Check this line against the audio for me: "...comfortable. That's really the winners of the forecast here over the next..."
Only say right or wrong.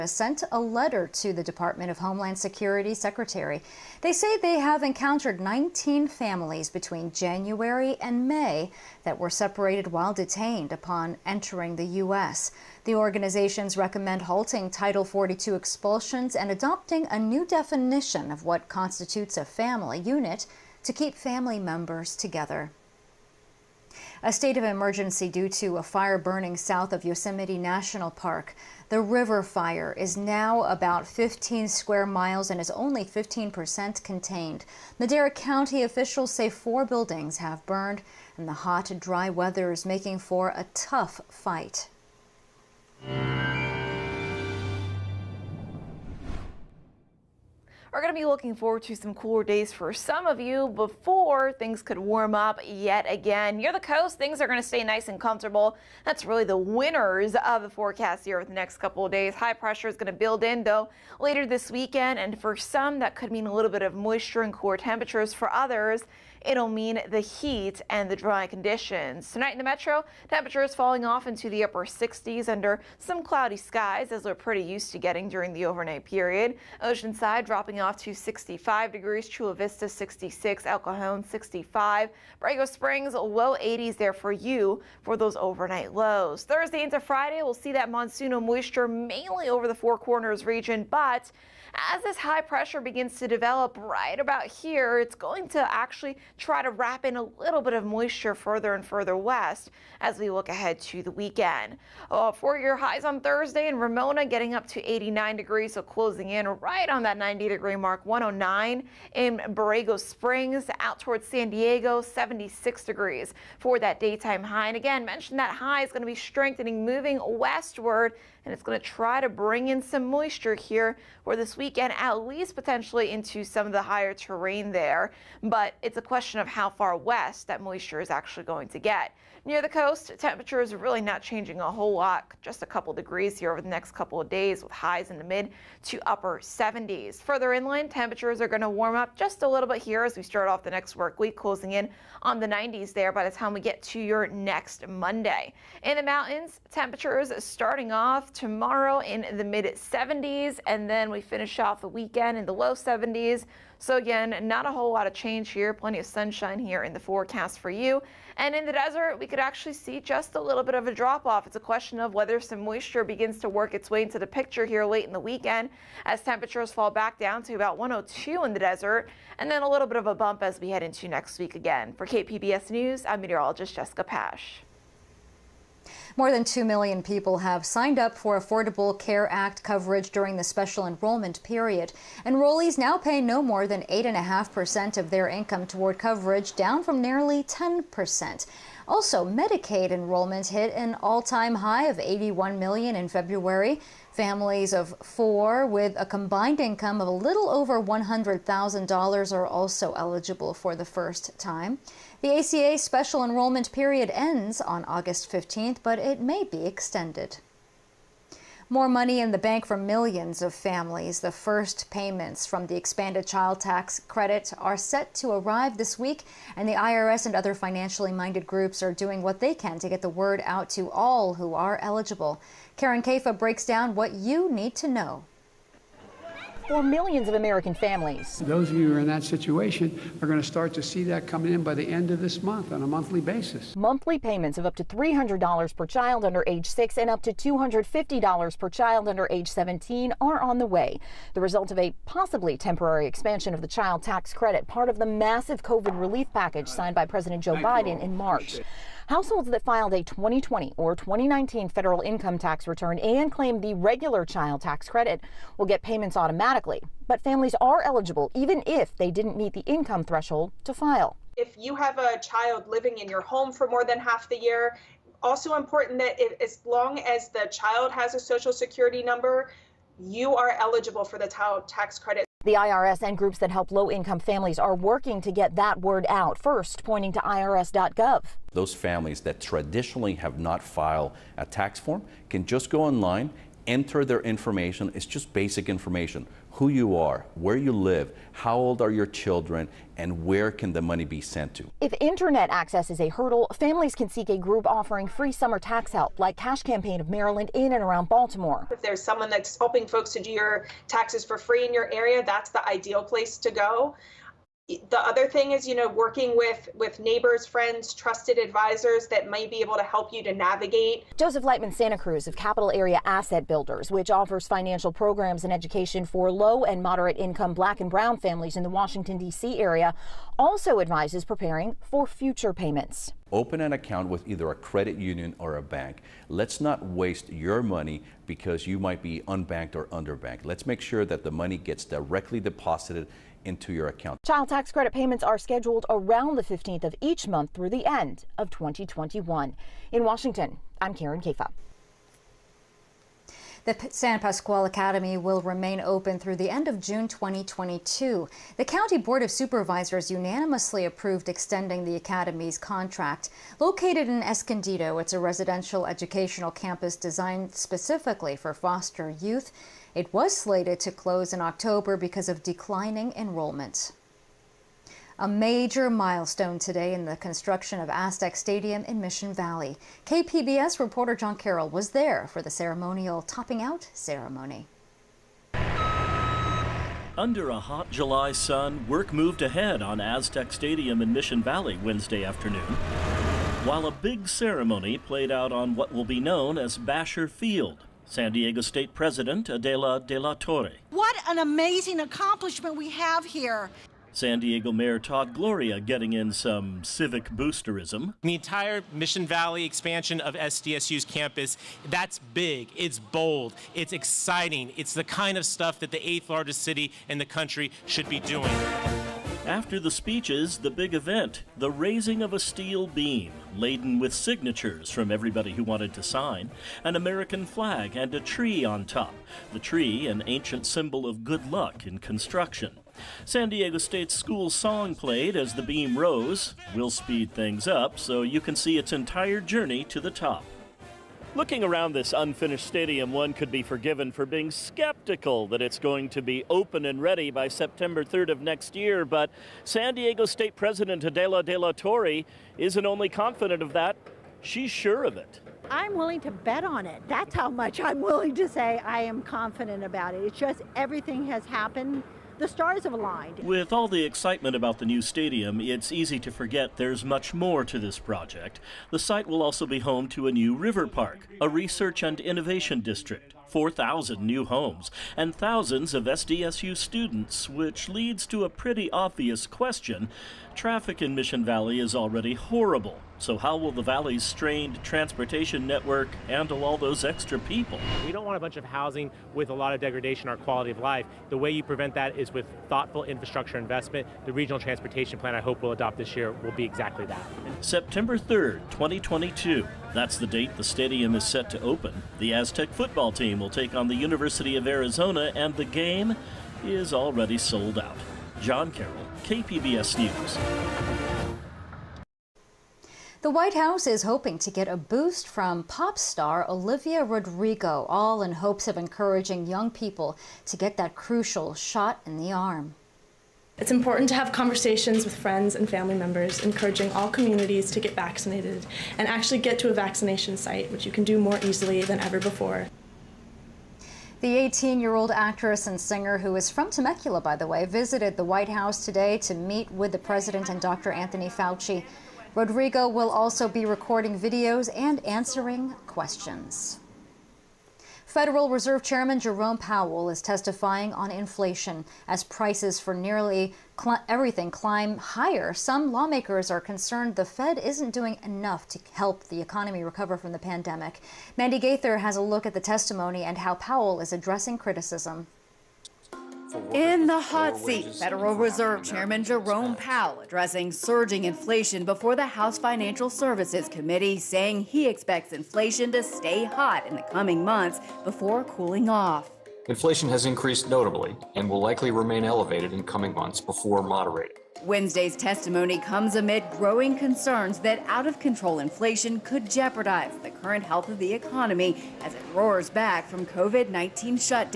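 right.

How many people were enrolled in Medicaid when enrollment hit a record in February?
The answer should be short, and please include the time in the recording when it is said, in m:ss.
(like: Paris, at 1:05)
81 million, at 3:11.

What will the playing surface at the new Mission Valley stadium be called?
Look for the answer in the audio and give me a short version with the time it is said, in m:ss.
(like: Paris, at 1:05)
Basher Field, at 6:26.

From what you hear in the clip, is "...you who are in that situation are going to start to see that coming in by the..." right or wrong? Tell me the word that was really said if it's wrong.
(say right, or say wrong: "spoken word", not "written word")
right.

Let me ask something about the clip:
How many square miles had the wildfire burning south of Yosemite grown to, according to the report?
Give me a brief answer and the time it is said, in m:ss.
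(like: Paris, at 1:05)
15, at 0:30.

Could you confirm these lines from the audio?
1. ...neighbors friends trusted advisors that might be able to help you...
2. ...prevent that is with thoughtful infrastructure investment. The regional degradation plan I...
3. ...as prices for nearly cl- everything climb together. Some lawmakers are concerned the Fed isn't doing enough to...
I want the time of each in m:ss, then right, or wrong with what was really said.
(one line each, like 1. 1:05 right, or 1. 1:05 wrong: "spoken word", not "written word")
1. 5:06 right
2. 8:01 wrong: "transportation", not "degradation"
3. 9:02 wrong: "higher", not "together".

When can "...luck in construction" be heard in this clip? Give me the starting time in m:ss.
7:01.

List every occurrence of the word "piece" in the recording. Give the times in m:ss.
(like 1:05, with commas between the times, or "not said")
not said.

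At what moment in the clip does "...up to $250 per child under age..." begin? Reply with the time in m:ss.
3:57.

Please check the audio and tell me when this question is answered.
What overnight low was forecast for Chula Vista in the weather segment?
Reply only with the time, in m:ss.
1:19.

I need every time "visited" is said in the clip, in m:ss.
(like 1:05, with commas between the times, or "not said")
8:47.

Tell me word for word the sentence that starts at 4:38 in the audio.
Those families that traditionally have not filed a tax form can just go online, enter their information.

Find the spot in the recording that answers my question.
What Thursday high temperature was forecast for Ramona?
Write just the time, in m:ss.
1:44.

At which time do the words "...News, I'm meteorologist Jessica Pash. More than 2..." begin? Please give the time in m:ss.
2:52.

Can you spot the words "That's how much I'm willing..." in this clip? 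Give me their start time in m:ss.
7:27.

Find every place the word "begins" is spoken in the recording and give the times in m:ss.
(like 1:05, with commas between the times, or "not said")
1:32, 2:43.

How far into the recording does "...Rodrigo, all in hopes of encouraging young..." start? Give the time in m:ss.
8:27.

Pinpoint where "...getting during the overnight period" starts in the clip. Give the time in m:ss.
1:14.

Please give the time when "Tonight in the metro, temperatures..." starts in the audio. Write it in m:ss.
1:09.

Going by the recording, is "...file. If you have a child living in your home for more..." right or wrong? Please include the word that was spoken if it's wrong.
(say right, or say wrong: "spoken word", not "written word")
right.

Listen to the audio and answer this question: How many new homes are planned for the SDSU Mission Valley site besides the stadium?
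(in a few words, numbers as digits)
4,000.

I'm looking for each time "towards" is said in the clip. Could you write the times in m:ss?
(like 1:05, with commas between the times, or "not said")
1:50, 3:05.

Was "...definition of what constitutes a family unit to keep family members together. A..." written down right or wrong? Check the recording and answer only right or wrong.
right.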